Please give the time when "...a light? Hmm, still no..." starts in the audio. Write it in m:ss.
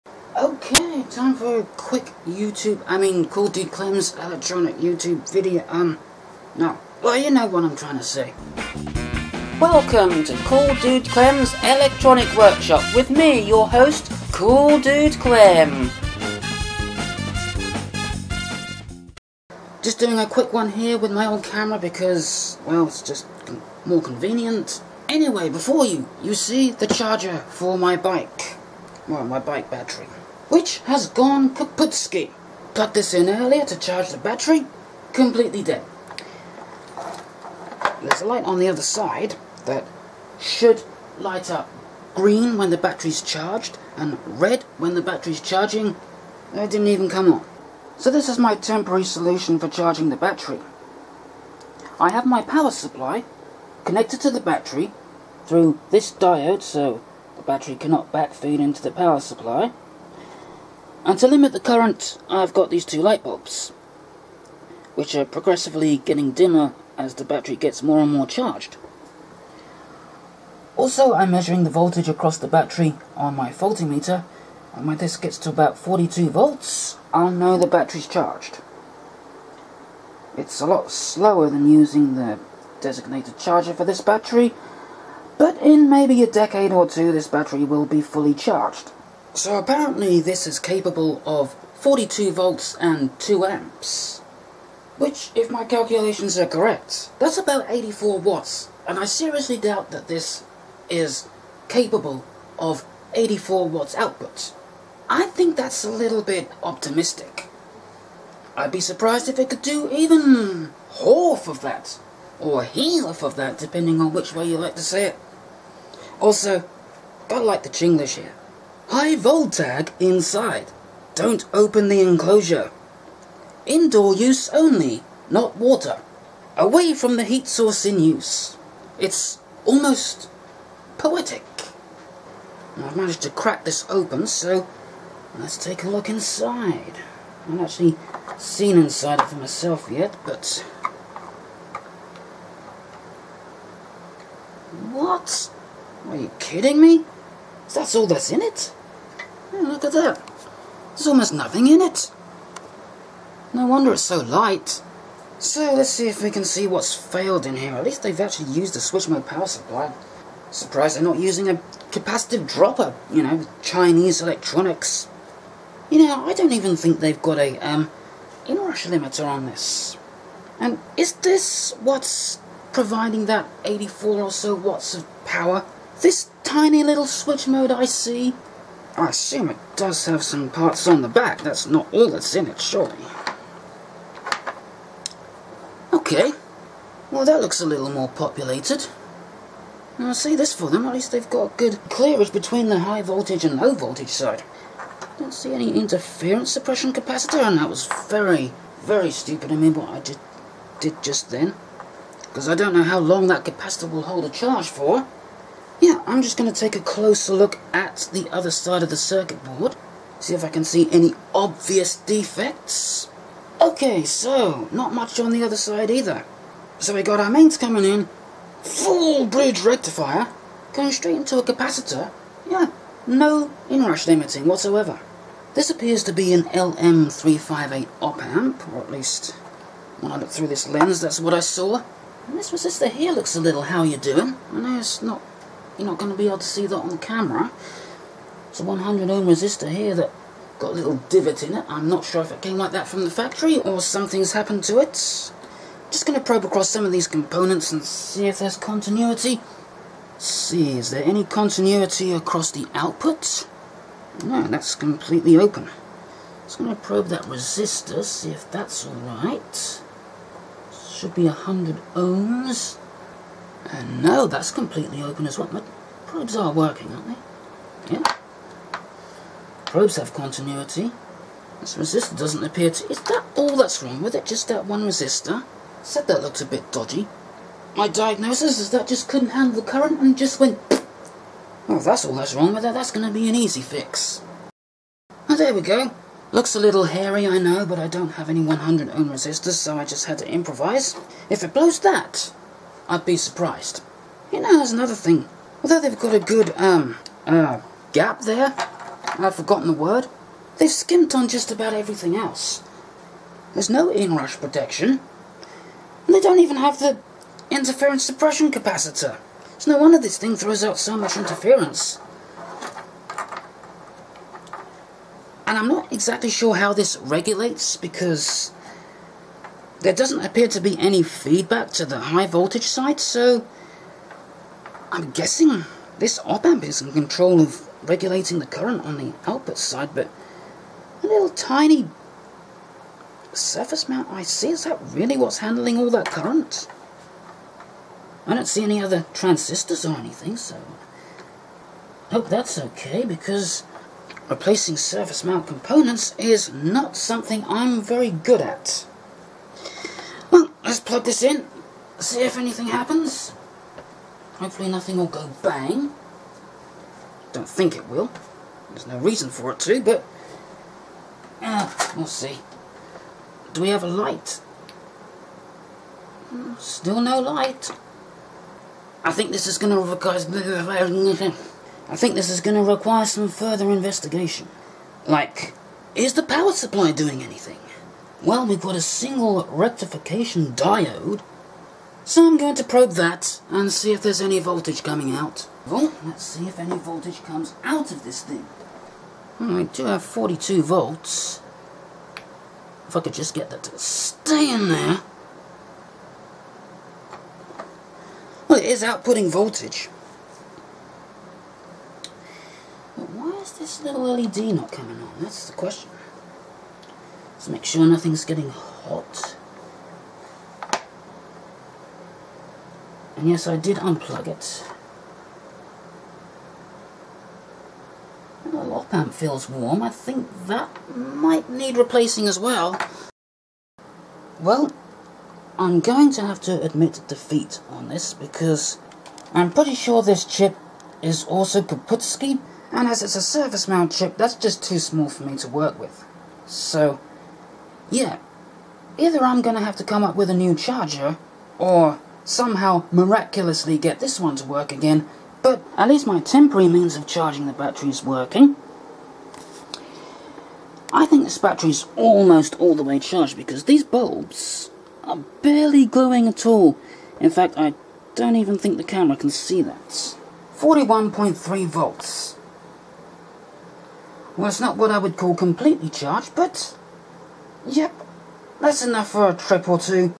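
6:03.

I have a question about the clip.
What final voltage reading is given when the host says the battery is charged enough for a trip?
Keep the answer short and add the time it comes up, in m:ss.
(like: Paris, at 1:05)
41.3 volts, at 7:40.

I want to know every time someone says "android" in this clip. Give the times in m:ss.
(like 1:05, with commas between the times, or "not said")
not said.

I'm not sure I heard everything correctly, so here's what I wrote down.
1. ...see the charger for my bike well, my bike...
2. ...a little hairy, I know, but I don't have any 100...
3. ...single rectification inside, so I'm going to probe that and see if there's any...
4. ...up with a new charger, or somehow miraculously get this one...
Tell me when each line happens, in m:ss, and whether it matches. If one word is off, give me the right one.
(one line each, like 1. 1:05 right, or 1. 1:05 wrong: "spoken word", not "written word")
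1. 0:26 right
2. 4:46 right
3. 6:18 wrong: "diode", not "inside"
4. 7:20 right.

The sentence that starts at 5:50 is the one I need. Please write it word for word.
Well, let's plug this in, see if anything happens.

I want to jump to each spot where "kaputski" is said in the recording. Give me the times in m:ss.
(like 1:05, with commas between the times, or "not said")
0:31, 7:11.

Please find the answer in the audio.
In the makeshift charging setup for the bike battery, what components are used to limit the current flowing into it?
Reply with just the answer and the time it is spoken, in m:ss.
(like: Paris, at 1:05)
two light bulbs, at 1:02.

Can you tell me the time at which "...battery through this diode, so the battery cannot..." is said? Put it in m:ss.
0:54.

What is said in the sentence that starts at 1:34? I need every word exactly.
Which, if my calculations are correct, that's about 84 watts.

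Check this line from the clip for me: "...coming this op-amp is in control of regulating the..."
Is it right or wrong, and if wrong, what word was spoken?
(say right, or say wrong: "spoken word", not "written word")
wrong: "guessing", not "coming".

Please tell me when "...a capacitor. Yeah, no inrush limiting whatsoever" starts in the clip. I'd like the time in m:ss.
3:41.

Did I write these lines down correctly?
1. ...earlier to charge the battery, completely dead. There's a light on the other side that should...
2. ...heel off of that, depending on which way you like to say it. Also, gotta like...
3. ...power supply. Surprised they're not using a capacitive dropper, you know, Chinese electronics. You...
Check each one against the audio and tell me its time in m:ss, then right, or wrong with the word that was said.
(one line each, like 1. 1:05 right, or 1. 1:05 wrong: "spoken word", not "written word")
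1. 0:33 right
2. 1:52 right
3. 2:39 right.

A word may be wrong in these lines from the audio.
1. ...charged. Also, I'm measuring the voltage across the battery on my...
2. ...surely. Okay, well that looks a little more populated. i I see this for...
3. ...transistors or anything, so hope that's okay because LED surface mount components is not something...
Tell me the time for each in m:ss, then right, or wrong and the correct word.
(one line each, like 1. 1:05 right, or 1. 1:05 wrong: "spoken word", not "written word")
1. 1:08 right
2. 3:02 right
3. 5:39 wrong: "Replacing", not "LED".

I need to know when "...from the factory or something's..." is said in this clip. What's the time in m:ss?
4:02.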